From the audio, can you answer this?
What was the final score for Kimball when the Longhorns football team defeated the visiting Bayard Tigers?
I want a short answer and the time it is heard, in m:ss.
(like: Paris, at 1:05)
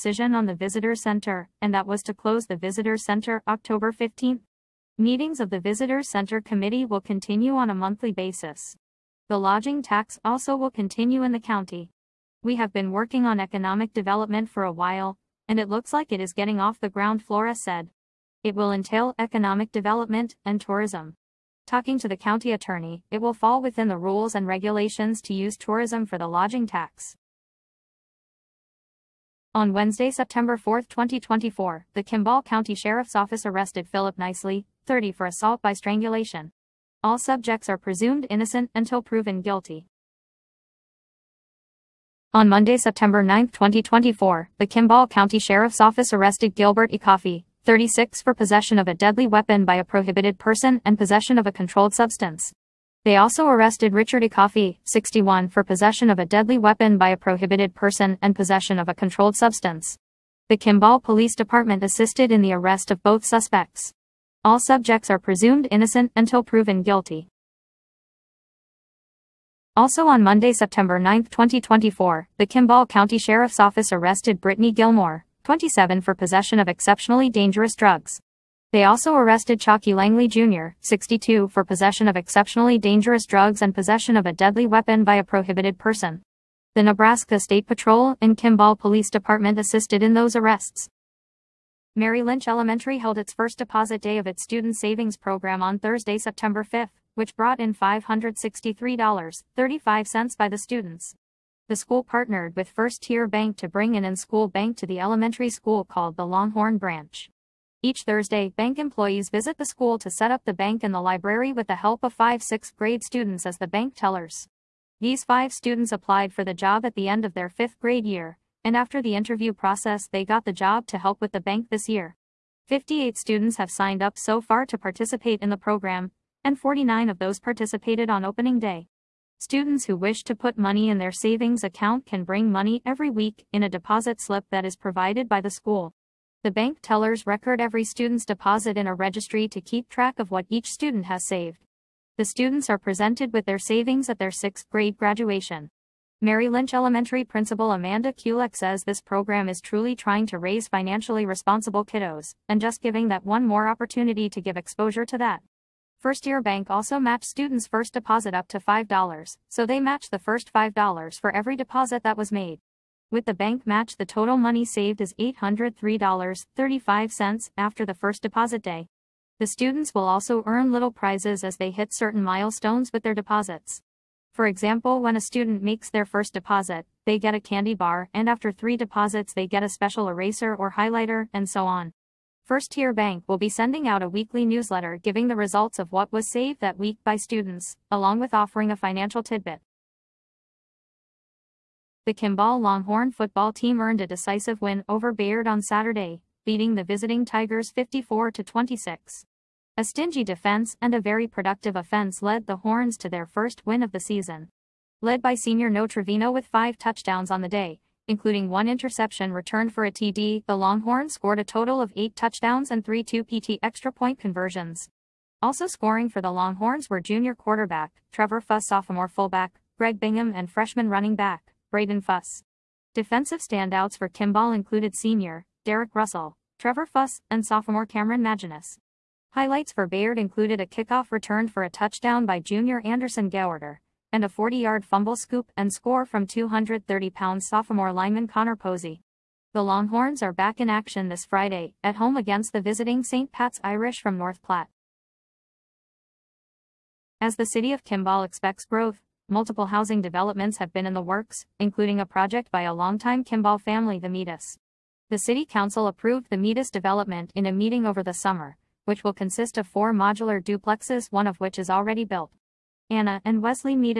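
54, at 3:17.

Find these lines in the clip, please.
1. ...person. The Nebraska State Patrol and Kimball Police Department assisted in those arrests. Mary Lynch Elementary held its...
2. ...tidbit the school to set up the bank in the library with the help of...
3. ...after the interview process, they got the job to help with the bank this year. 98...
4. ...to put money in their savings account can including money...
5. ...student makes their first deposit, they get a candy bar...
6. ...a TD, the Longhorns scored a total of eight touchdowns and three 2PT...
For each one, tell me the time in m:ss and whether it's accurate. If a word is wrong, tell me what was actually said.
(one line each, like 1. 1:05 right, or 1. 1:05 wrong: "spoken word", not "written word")
1. 1:25 right
2. 1:49 wrong: "visit", not "tidbit"
3. 1:58 wrong: "58", not "98"
4. 2:10 wrong: "bring", not "including"
5. 2:55 right
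6. 3:29 right.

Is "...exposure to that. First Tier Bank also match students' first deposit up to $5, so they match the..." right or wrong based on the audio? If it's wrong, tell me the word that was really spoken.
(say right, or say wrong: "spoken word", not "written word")
right.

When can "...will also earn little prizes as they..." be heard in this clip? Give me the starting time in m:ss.
2:49.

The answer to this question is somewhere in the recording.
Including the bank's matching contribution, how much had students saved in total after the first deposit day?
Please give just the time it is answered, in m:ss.
2:45.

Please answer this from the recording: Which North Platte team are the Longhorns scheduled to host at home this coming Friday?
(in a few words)
St. Pat's Irish.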